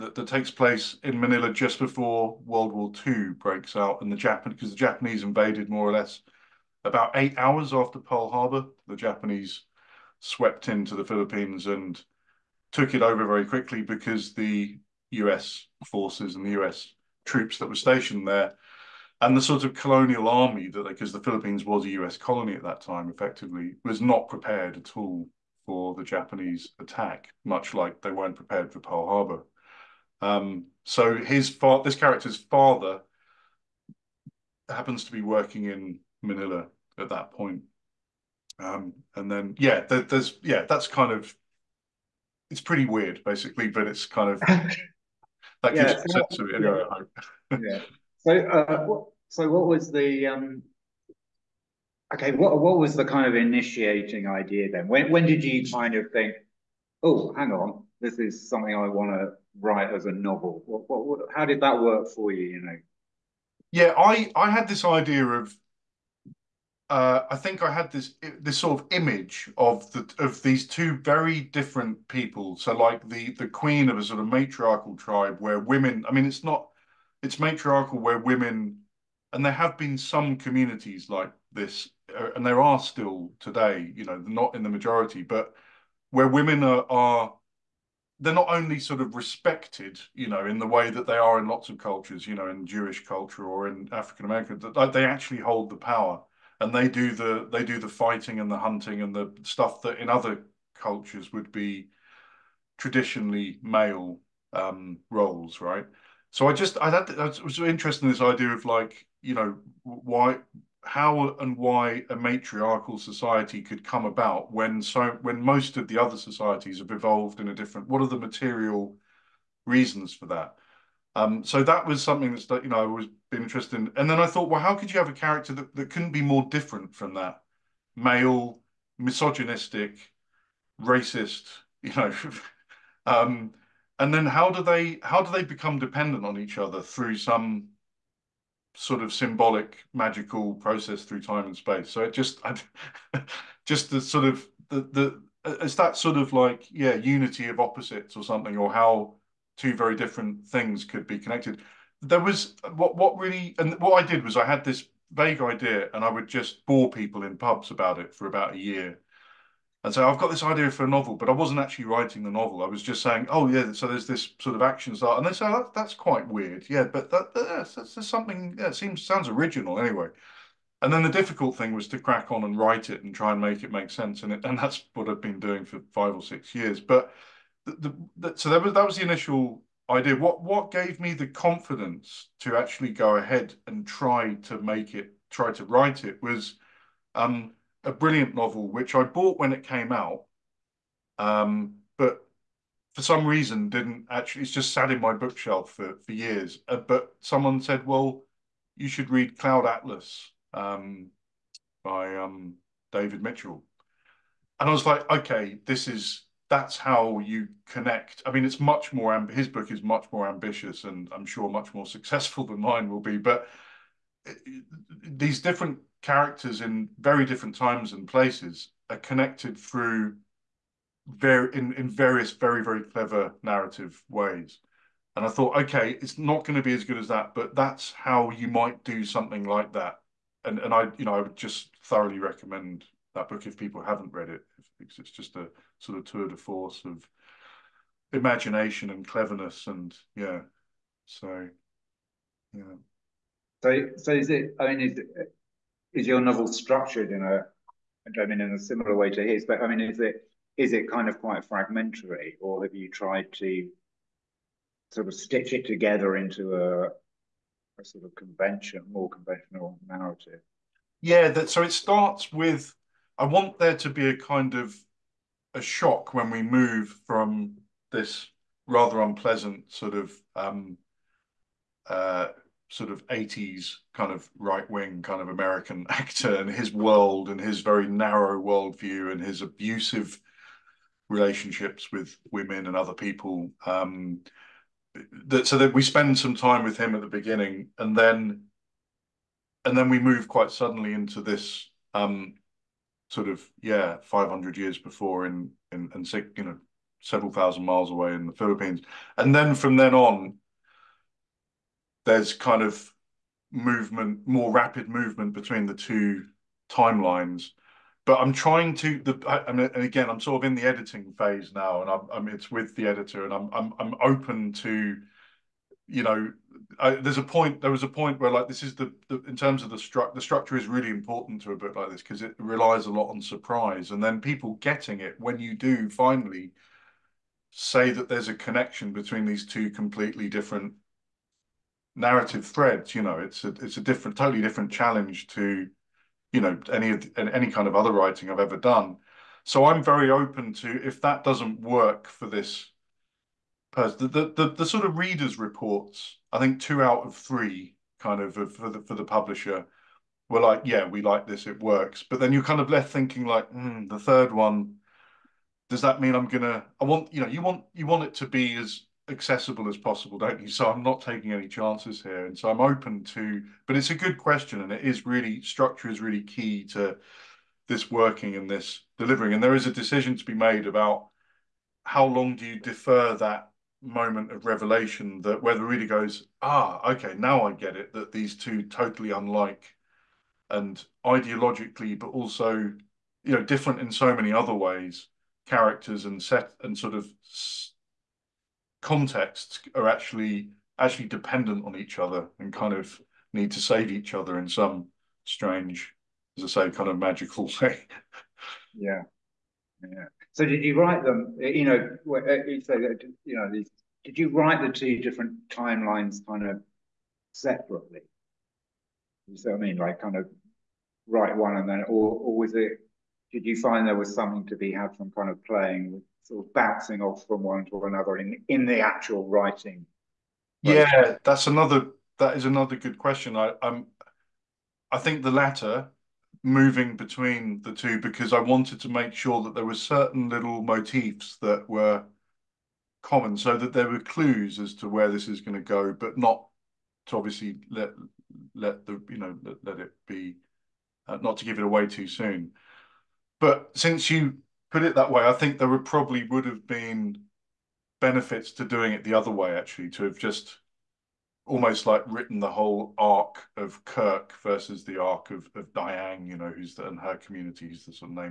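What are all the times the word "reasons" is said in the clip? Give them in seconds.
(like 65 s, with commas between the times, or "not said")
119 s, 193 s.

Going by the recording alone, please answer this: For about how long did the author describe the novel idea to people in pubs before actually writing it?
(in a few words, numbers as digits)
About a year.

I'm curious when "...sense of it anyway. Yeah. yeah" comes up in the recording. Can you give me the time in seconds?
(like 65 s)
46 s.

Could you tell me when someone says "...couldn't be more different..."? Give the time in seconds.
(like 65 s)
125 s.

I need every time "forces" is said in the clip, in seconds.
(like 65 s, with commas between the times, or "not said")
15 s, 236 s.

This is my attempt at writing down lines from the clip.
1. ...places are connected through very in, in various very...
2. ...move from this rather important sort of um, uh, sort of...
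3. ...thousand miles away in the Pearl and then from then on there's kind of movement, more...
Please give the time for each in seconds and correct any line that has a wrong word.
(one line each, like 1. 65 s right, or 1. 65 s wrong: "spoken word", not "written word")
1. 218 s right
2. 266 s wrong: "unpleasant", not "important"
3. 297 s wrong: "Philippines", not "Pearl".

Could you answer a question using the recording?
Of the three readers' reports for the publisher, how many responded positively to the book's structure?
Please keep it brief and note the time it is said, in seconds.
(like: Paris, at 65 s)
2, at 346 s.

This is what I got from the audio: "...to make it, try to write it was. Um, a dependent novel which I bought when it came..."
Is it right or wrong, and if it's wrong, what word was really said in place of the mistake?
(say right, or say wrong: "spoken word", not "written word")
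wrong: "brilliant", not "dependent".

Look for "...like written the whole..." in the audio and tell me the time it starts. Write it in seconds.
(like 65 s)
451 s.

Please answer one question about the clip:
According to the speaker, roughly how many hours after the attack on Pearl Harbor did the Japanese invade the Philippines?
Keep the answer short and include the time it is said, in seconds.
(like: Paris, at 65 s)
8, at 7 s.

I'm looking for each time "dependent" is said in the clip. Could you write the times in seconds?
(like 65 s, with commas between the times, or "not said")
135 s, 391 s.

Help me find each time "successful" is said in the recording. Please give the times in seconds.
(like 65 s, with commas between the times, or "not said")
211 s.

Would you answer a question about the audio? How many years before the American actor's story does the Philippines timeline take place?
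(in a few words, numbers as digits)
500.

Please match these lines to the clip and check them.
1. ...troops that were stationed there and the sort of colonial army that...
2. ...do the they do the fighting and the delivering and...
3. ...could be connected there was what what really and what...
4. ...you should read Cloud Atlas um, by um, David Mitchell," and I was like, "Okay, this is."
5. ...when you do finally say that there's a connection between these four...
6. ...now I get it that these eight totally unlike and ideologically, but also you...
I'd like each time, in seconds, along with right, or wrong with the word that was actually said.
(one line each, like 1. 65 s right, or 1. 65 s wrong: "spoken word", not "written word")
1. 17 s right
2. 96 s wrong: "hunting", not "delivering"
3. 150 s right
4. 198 s right
5. 325 s wrong: "two", not "four"
6. 377 s wrong: "two", not "eight".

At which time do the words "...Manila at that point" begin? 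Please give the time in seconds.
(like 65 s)
36 s.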